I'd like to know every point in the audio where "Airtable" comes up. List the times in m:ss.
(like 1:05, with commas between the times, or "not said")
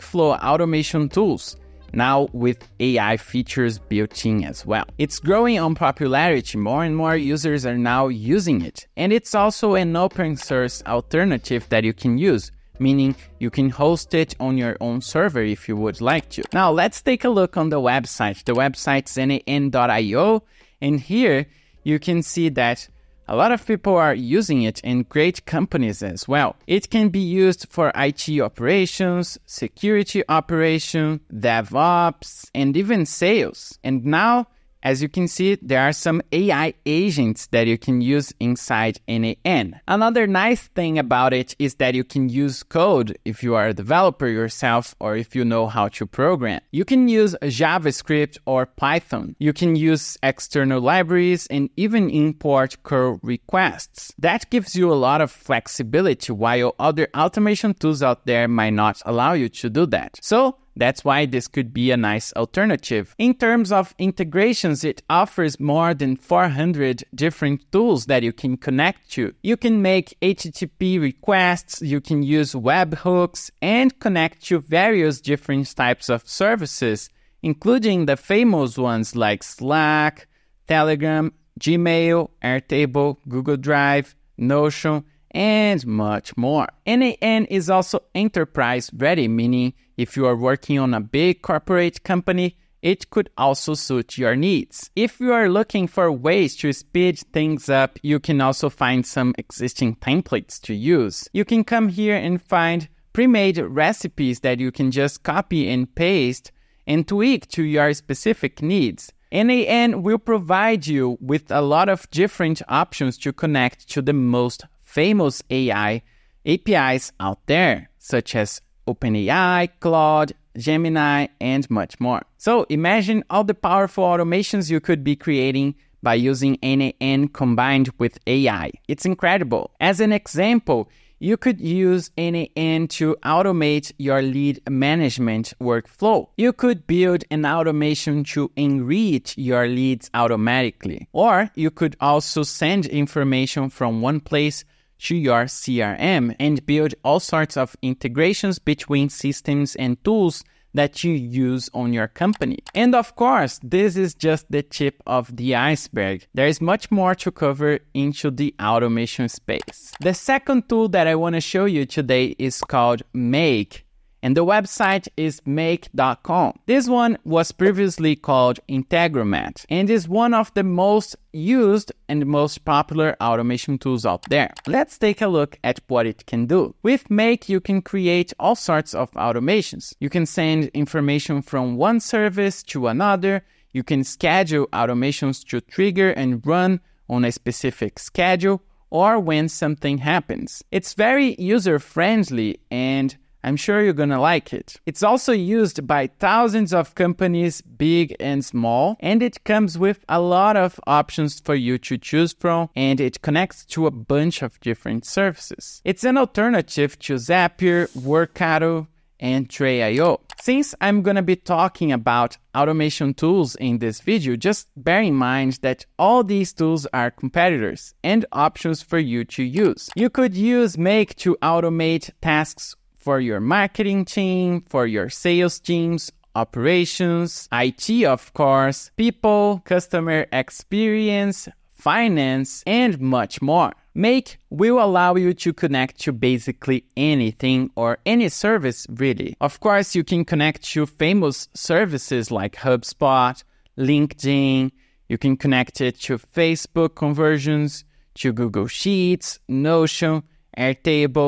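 1:22, 4:10.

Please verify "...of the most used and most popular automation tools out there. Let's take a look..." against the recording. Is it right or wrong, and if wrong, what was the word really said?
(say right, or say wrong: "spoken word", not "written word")
right.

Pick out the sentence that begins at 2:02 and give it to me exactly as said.
So imagine all the powerful automations you could be creating by using N8N combined with AI.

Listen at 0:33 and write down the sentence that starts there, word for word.
And now as you can see, there are some AI agents that you can use inside N8N.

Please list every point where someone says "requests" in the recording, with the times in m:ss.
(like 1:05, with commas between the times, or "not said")
0:53, 1:10.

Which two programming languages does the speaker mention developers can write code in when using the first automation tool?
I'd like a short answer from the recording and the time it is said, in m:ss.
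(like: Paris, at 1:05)
JavaScript or Python, at 0:47.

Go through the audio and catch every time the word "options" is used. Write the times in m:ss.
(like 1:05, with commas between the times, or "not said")
1:52, 3:20, 3:38.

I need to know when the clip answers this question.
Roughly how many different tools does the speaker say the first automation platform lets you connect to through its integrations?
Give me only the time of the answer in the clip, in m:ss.
1:05.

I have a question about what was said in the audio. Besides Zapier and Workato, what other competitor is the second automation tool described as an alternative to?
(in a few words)
Tray.io.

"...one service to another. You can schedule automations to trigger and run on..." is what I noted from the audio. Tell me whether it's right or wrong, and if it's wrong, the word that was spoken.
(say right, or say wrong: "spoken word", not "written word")
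right.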